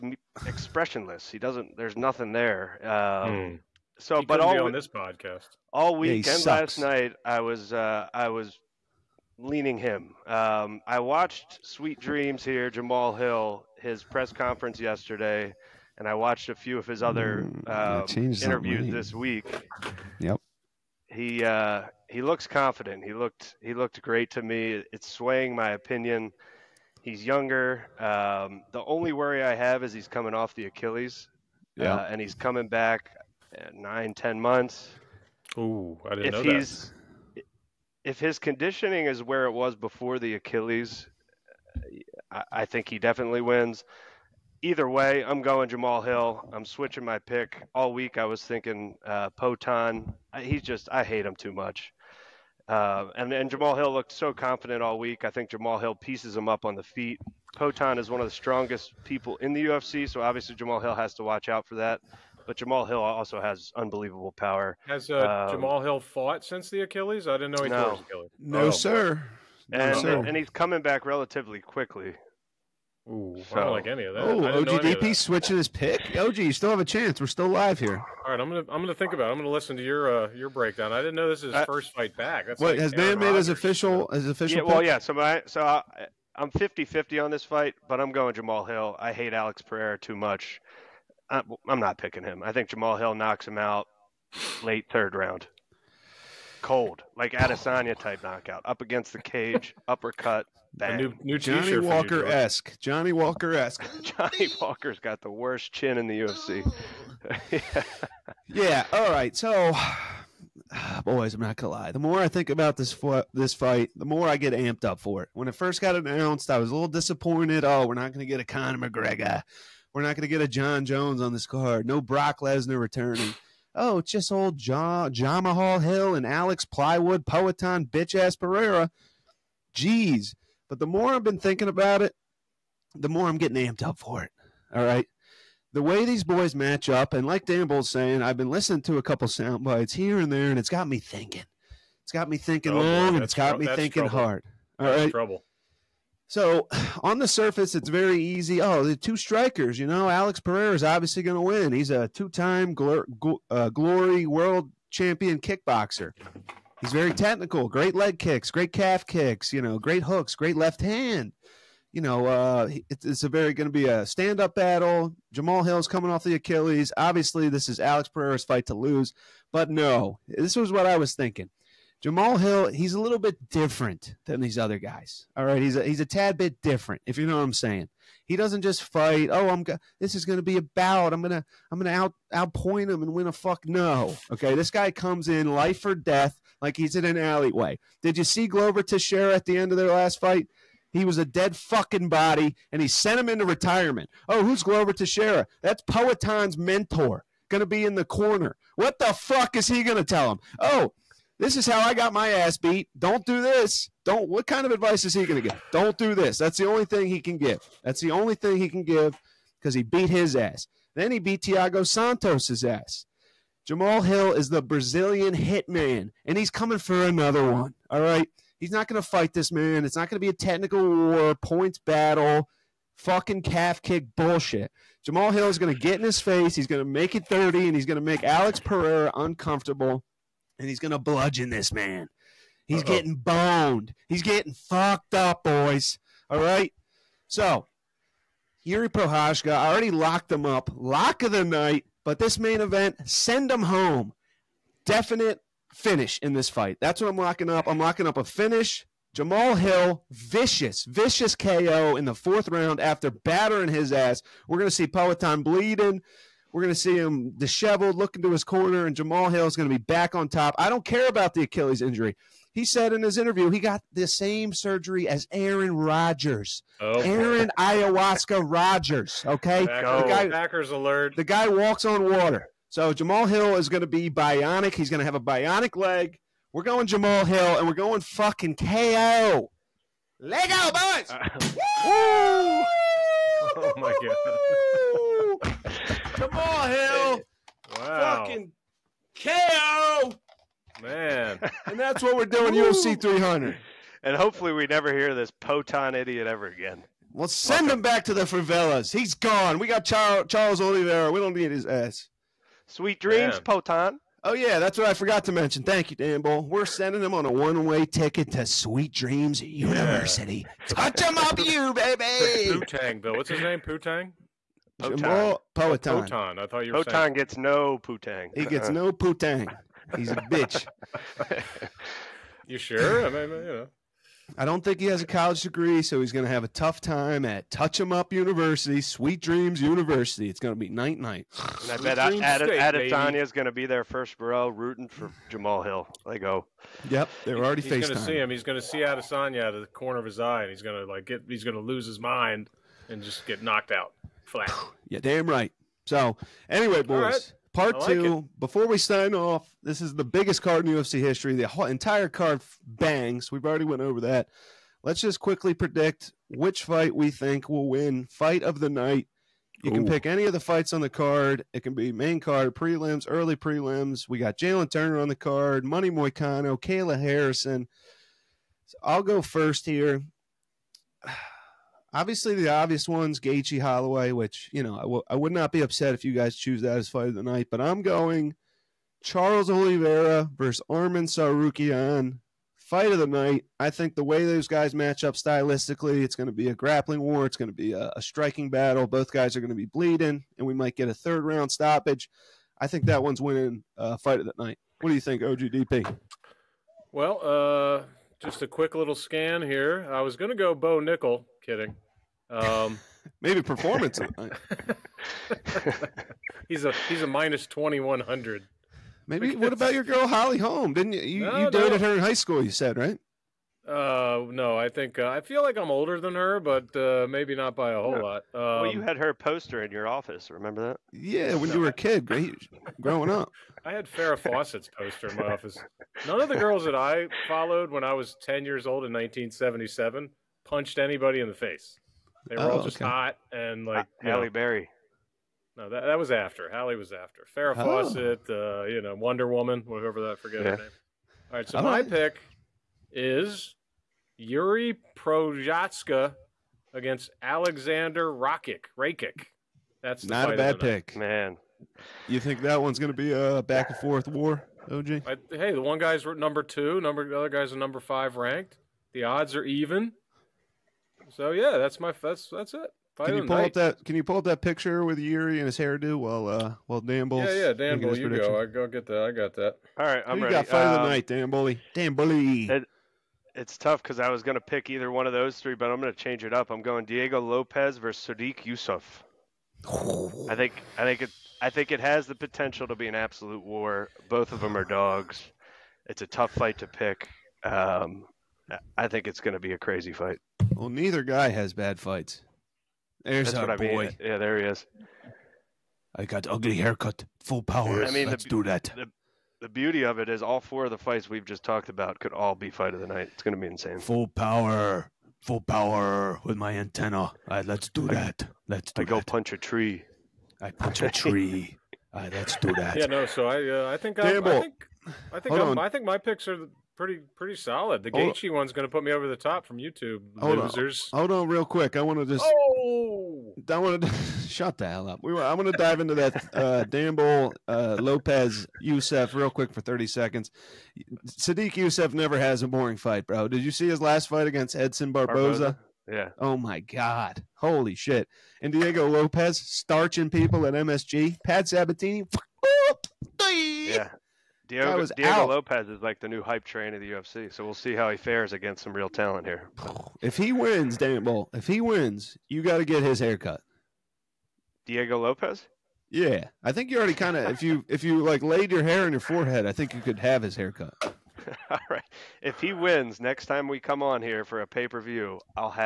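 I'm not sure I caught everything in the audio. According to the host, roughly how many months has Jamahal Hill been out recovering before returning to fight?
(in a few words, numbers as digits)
9-10 months.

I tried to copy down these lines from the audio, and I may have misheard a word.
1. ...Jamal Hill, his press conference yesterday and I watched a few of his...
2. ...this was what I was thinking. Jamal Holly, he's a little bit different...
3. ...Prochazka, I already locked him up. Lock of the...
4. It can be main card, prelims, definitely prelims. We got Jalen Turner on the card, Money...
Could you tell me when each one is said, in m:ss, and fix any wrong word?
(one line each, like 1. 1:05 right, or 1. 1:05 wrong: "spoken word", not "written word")
1. 0:12 right
2. 2:50 wrong: "Hill", not "Holly"
3. 3:58 right
4. 6:01 wrong: "early", not "definitely".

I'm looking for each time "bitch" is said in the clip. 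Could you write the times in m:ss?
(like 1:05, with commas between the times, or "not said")
2:07, 5:20.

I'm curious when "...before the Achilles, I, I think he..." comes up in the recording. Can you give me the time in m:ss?
0:39.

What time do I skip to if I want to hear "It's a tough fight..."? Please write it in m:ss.
8:05.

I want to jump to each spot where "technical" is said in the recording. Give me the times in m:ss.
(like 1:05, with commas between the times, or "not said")
2:37, 3:40.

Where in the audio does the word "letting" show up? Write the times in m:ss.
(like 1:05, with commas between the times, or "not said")
not said.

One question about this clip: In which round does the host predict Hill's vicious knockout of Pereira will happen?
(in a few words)
Fourth round.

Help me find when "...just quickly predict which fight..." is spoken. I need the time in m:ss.
5:54.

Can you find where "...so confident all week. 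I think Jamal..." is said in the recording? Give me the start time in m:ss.
0:54.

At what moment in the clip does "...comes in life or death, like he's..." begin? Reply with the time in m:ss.
3:04.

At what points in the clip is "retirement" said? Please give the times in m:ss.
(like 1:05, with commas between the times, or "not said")
3:13.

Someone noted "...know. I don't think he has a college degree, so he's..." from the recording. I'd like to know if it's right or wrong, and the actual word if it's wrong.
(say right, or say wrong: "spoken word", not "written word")
right.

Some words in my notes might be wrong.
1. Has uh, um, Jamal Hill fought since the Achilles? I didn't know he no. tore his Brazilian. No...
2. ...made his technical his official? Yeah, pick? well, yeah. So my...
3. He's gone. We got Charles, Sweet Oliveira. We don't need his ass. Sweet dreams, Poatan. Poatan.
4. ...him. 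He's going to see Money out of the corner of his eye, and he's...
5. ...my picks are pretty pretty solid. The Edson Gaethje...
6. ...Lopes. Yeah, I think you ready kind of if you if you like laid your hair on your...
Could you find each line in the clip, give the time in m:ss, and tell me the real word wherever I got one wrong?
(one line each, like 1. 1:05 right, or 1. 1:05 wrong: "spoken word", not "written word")
1. 1:04 wrong: "Achilles", not "Brazilian"
2. 1:23 wrong: "official", not "technical"
3. 4:58 wrong: "Charles", not "Sweet"
4. 5:38 wrong: "Adesanya", not "Money"
5. 8:35 wrong: "Hold", not "Edson"
6. 9:14 wrong: "already", not "ready".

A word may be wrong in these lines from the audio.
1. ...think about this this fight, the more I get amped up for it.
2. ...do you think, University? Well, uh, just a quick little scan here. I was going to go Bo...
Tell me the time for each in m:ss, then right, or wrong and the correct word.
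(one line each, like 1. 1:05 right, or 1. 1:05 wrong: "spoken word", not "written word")
1. 1:52 right
2. 6:34 wrong: "OGDP", not "University".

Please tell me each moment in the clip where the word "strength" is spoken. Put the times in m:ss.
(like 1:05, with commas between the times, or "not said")
not said.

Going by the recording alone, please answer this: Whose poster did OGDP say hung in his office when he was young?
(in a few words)
Farrah Fawcett.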